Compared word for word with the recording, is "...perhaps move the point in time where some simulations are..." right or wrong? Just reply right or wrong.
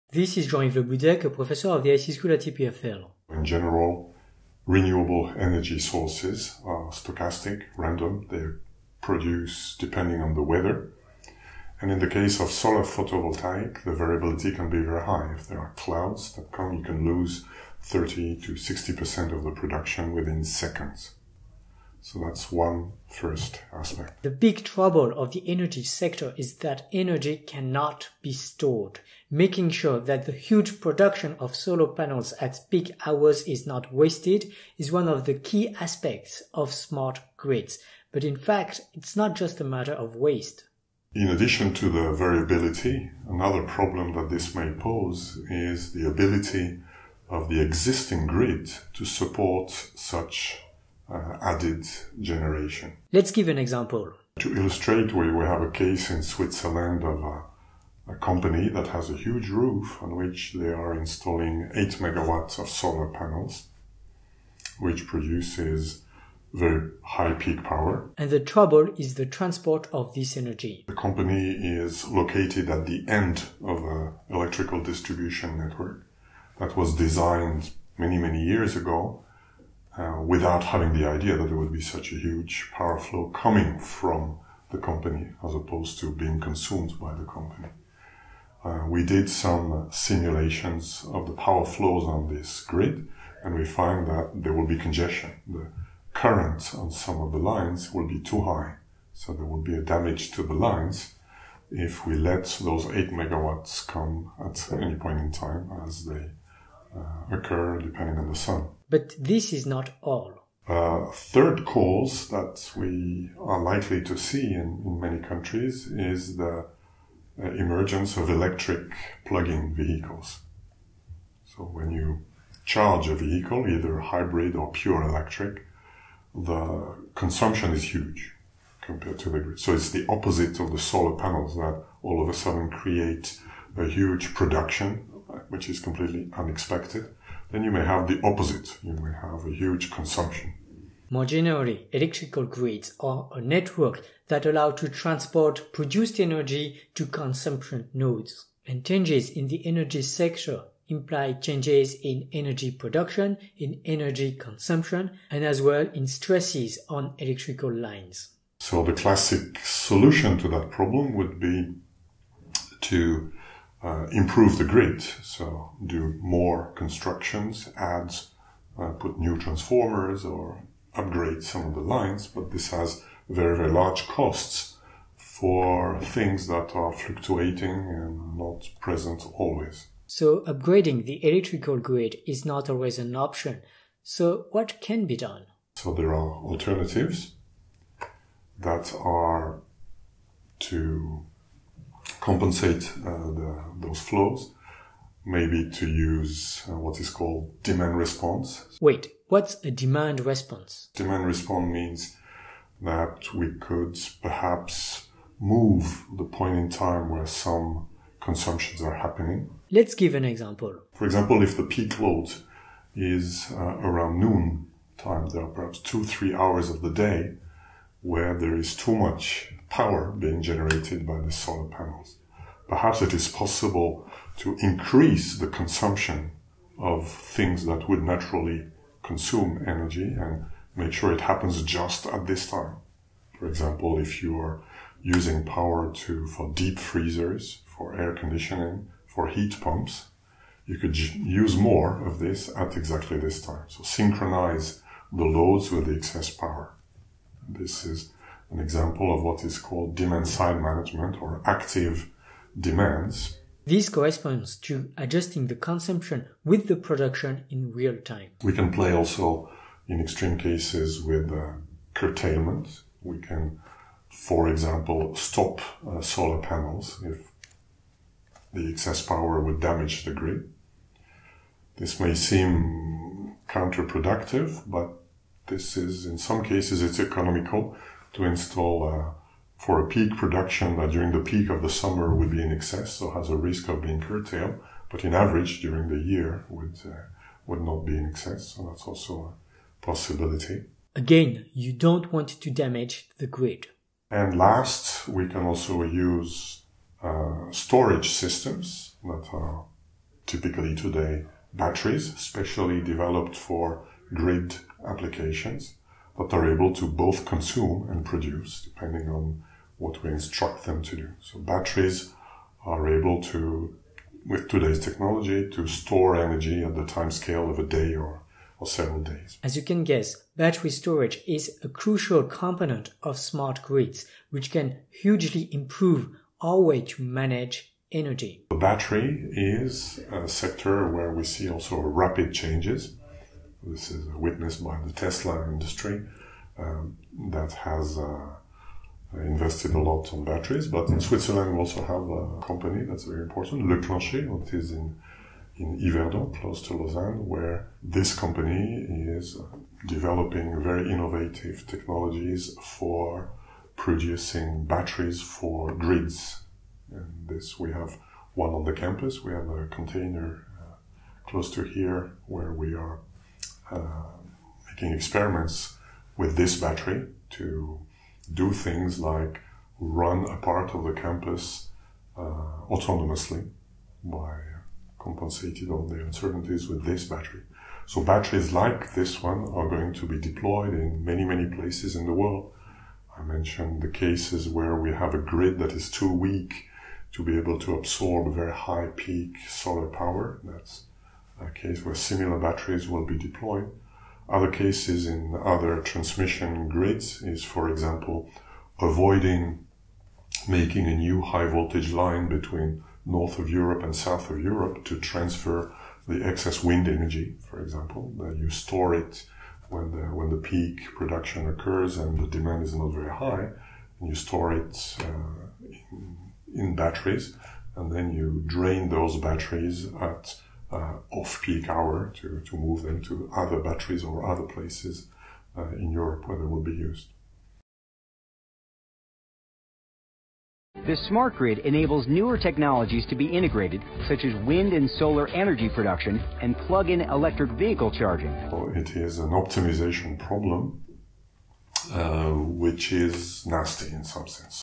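wrong.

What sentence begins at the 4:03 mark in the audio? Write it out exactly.
So synchronize the loads with the excess power.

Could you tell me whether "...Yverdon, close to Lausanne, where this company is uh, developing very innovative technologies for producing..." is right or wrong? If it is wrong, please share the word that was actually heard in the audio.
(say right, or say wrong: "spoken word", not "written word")
right.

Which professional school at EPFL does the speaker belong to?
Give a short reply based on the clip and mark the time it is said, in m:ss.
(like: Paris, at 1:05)
IC School, at 0:01.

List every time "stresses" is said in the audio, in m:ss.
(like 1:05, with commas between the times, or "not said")
2:36.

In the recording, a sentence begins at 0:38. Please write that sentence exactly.
But in fact, it's not just a matter of waste.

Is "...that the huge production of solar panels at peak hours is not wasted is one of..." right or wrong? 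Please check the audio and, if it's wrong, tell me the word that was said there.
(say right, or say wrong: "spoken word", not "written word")
right.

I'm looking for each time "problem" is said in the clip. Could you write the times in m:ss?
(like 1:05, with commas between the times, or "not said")
0:43, 2:40, 7:20.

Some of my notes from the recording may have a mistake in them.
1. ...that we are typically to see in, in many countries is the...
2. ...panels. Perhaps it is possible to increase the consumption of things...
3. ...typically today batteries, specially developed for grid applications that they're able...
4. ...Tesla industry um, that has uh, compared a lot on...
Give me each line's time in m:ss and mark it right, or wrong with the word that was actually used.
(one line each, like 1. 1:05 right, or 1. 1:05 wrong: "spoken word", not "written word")
1. 1:52 wrong: "likely", not "typically"
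2. 3:41 right
3. 5:00 right
4. 5:34 wrong: "invested", not "compared".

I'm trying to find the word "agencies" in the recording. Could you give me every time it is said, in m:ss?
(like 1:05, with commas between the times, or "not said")
not said.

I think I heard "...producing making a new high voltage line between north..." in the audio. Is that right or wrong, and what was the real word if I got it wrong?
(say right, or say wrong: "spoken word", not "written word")
wrong: "avoiding", not "producing".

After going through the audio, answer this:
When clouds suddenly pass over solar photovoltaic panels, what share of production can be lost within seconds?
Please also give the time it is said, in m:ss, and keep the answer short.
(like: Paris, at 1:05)
30 to 60%, at 0:17.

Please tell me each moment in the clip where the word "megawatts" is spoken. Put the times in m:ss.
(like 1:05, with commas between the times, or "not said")
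1:01, 1:43.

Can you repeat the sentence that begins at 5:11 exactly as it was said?
So batteries are able to, with today's technology, to store energy at the time scale of a day or, or several days.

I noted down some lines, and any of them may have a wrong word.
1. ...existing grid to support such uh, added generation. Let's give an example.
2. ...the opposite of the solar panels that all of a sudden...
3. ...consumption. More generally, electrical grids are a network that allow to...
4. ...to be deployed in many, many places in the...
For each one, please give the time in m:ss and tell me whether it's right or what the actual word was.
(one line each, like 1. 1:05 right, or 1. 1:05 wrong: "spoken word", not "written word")
1. 0:47 right
2. 2:09 right
3. 2:19 right
4. 6:19 right.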